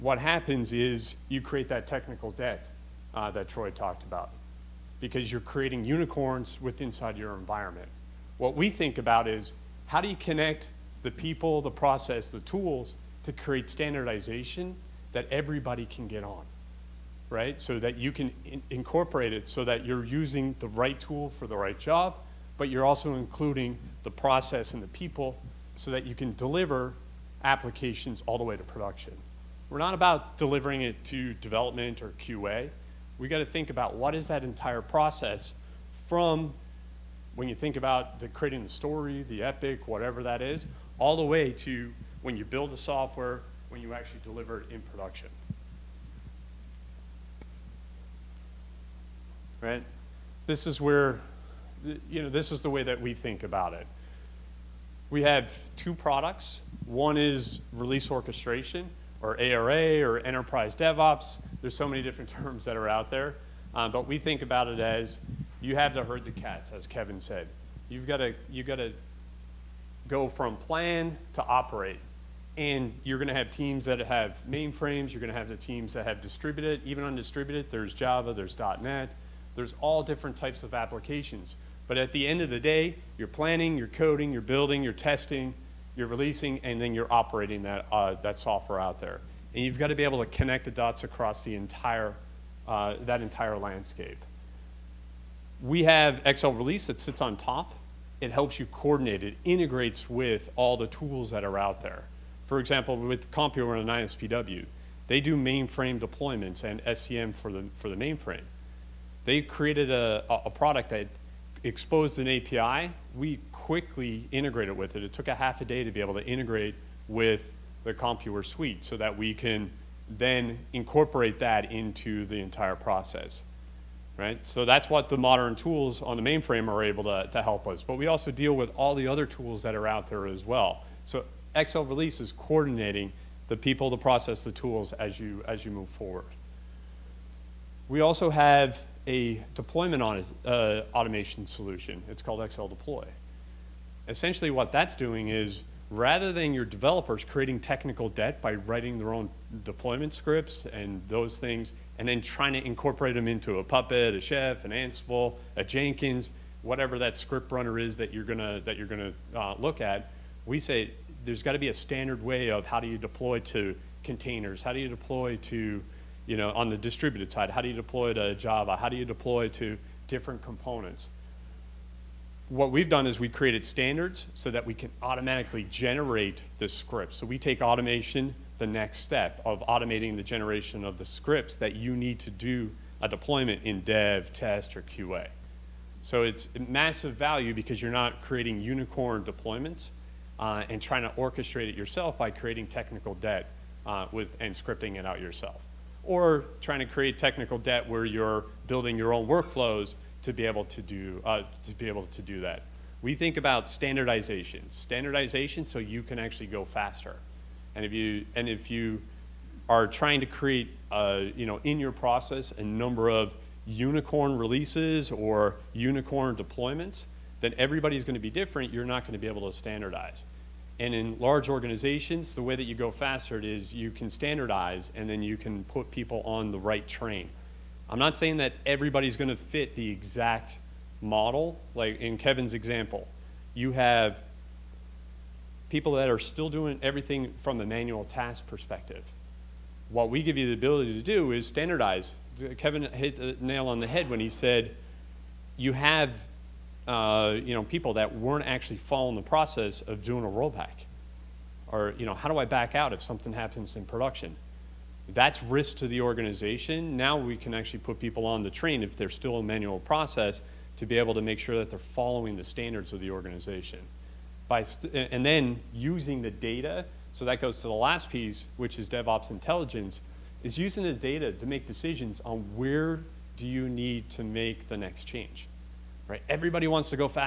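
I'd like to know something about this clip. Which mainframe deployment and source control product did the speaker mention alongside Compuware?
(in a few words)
ISPW.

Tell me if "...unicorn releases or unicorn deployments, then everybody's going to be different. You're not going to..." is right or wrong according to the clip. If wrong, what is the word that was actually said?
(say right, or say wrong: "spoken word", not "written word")
right.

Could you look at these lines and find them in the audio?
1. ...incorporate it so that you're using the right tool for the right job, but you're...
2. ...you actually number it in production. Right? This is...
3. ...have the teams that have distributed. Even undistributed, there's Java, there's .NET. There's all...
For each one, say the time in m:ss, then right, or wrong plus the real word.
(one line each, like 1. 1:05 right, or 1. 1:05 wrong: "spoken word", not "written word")
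1. 0:18 right
2. 0:43 wrong: "deliver", not "number"
3. 1:15 right.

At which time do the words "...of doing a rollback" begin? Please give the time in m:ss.
4:09.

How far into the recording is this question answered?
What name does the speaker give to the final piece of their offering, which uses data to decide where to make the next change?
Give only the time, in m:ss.
4:28.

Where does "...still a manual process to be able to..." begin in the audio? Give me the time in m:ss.
4:19.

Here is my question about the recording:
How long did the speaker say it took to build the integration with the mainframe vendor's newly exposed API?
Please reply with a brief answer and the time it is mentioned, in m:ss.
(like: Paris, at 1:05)
Half a day, at 1:55.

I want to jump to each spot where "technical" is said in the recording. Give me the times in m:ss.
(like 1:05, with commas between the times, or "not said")
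0:01, 2:27, 3:12, 3:17.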